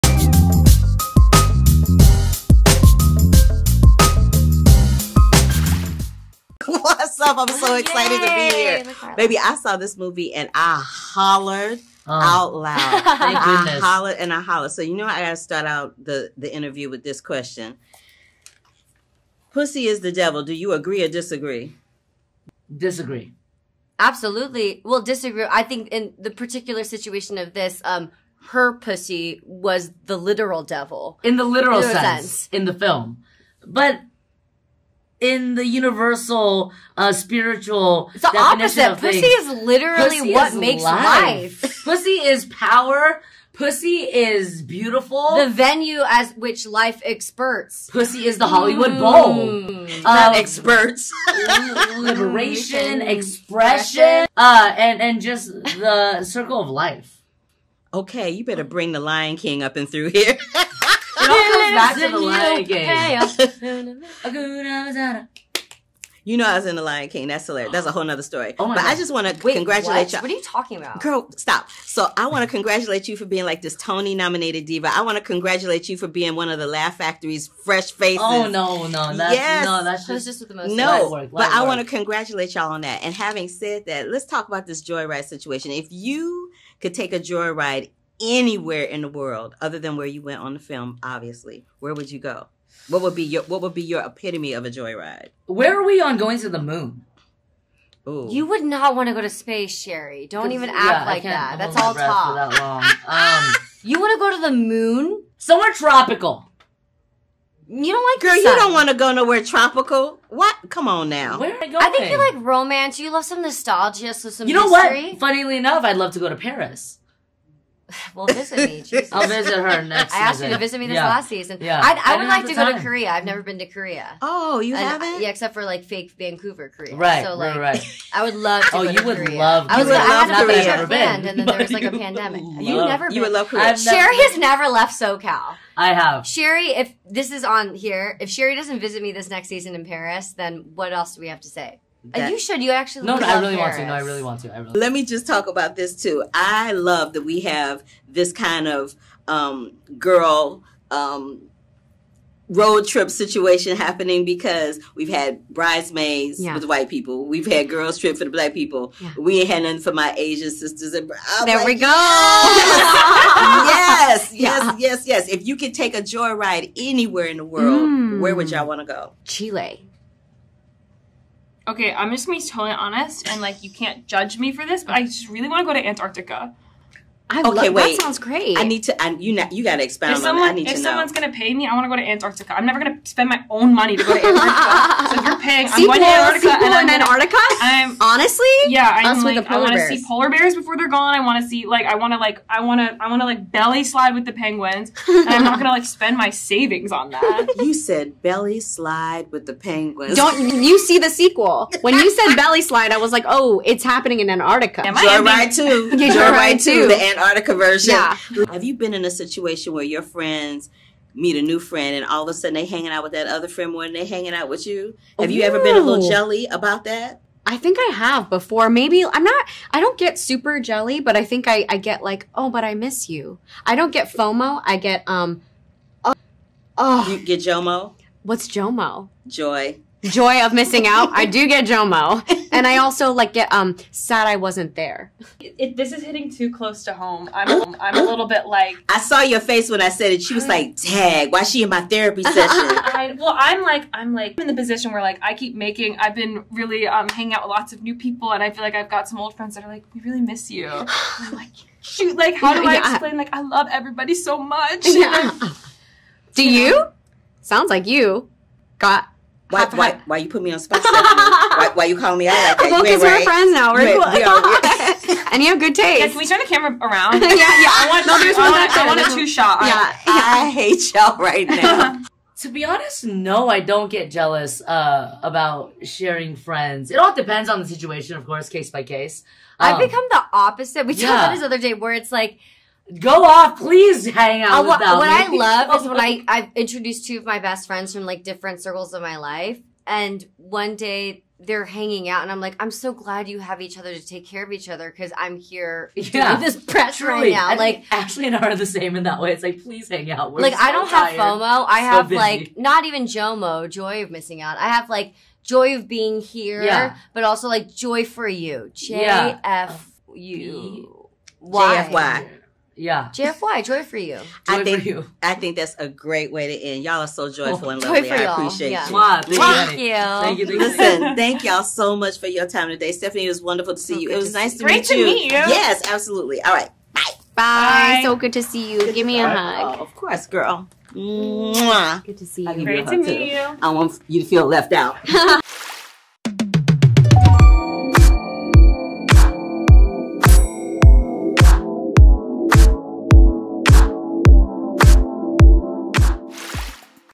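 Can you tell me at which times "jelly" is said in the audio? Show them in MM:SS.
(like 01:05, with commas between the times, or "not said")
03:36, 03:40.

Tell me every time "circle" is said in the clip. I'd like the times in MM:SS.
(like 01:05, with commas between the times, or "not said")
00:56, 04:48.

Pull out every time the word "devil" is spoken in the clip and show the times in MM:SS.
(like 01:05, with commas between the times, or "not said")
00:20, 00:30.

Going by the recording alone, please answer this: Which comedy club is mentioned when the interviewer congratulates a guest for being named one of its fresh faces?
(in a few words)
Laugh Factory.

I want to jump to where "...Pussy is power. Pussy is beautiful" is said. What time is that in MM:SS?
00:41.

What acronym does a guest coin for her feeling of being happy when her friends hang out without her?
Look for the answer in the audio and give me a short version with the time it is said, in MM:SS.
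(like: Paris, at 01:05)
JFY, at 05:13.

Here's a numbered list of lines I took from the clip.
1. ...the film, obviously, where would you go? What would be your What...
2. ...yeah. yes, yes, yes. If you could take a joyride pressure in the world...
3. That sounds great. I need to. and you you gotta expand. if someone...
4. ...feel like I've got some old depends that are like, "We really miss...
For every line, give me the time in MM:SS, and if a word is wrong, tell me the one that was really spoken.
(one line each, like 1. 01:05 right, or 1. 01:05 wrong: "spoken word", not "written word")
1. 01:30 right
2. 02:44 wrong: "anywhere", not "pressure"
3. 02:57 right
4. 04:08 wrong: "friends", not "depends".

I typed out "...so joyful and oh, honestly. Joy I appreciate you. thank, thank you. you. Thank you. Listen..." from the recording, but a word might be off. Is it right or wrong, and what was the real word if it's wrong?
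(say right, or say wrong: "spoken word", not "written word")
wrong: "lovely", not "honestly".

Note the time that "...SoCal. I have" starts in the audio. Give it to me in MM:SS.
02:14.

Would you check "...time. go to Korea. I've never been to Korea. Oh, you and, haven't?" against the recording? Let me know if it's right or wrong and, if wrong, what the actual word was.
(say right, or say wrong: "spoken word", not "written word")
right.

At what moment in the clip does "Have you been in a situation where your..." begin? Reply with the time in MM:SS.
03:28.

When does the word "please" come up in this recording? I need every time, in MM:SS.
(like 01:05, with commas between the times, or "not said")
04:43, 04:59.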